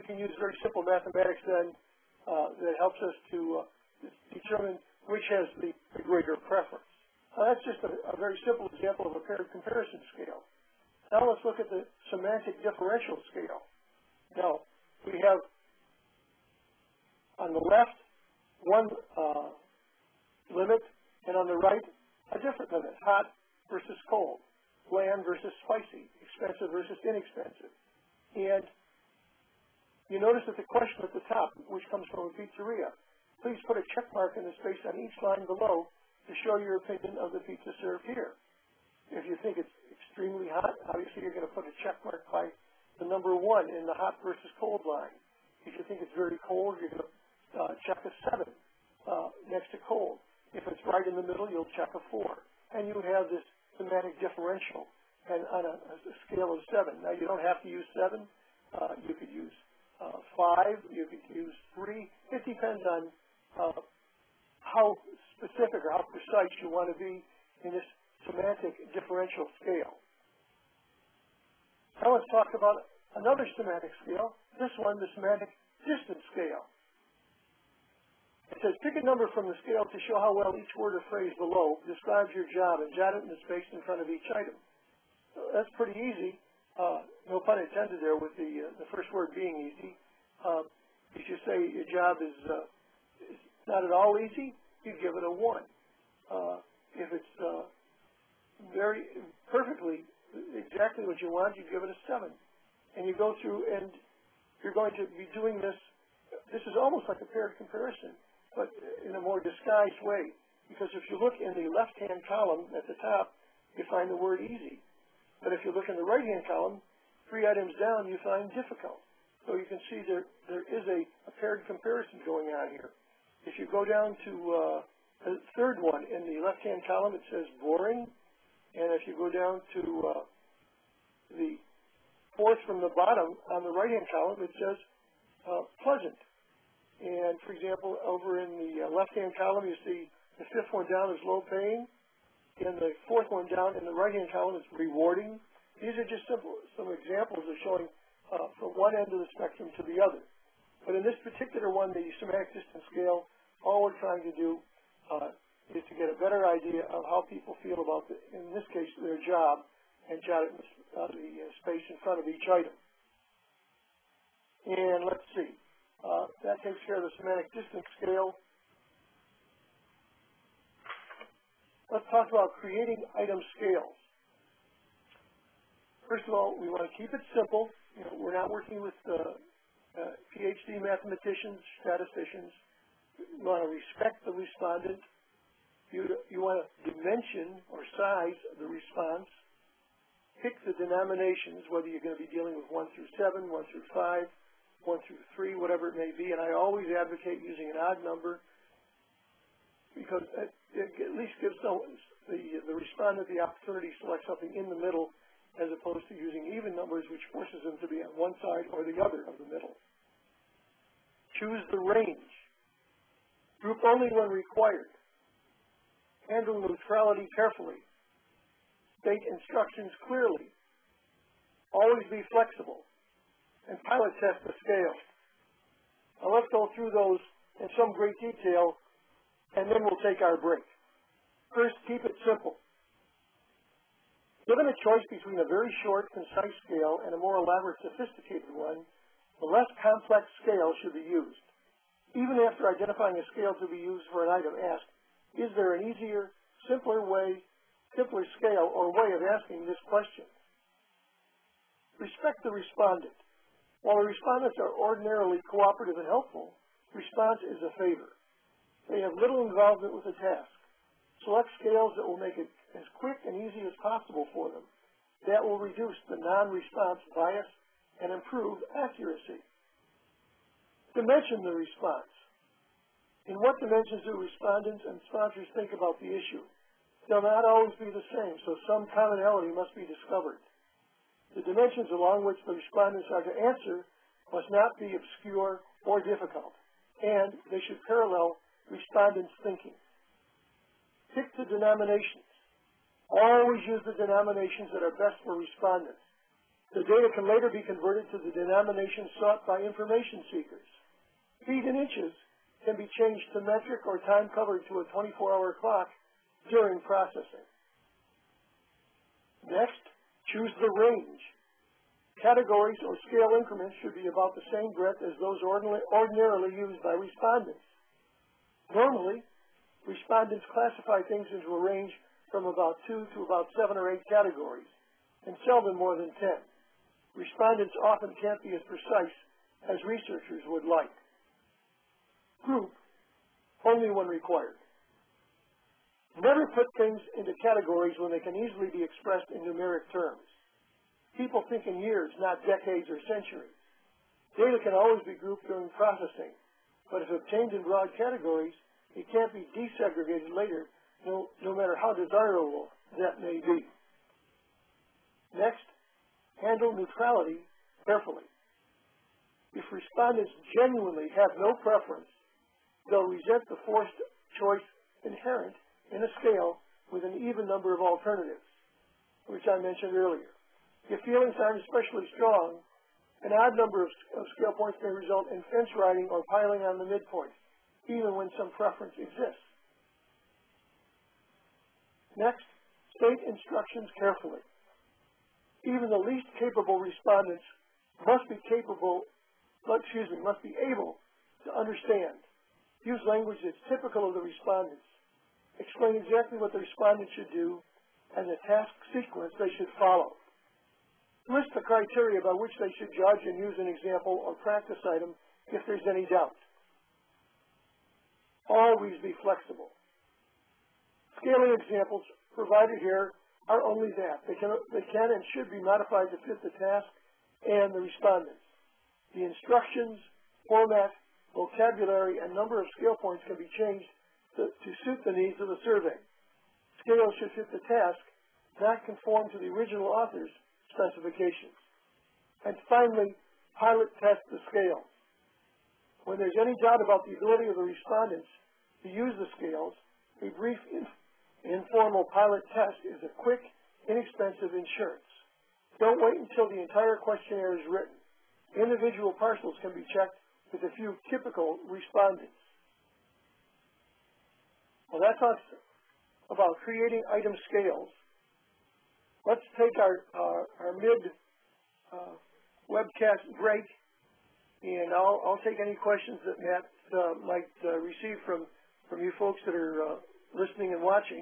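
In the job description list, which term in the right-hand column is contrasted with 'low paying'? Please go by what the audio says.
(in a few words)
Rewarding.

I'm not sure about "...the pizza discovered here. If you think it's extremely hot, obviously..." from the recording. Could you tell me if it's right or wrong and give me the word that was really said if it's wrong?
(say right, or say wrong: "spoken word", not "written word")
wrong: "served", not "discovered".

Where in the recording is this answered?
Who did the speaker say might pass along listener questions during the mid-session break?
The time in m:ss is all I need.
7:46.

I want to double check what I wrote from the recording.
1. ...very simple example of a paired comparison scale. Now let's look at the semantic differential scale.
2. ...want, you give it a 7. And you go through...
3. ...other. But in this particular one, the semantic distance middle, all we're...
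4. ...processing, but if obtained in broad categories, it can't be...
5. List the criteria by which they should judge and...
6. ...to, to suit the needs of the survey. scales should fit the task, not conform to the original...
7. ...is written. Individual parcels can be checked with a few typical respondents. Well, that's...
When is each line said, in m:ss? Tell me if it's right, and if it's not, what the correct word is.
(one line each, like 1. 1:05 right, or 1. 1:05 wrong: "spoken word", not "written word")
1. 0:08 right
2. 1:41 right
3. 2:29 wrong: "scale", not "middle"
4. 5:45 right
5. 6:41 right
6. 7:04 right
7. 7:27 right.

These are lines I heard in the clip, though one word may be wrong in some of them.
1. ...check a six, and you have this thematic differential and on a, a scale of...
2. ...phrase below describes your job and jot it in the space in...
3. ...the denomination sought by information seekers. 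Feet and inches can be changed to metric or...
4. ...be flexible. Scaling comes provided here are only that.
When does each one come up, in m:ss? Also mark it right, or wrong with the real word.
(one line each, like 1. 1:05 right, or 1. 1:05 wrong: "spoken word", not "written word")
1. 0:51 wrong: "four", not "six"
2. 1:21 right
3. 4:58 right
4. 6:49 wrong: "examples", not "comes".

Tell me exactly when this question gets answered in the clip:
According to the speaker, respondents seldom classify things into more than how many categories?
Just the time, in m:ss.
5:26.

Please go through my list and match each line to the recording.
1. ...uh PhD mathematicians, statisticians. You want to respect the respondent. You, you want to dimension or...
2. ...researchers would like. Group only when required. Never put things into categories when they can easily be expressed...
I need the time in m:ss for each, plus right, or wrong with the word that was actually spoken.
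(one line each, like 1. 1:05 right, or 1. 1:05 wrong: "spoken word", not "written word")
1. 2:59 right
2. 5:29 right.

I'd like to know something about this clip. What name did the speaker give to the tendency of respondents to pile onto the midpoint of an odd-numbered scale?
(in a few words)
Fence riding.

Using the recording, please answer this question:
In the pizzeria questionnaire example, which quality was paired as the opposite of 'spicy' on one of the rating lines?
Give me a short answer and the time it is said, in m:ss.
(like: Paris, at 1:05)
Bland, at 0:24.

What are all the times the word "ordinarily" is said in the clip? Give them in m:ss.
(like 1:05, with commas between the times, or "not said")
4:14, 5:15.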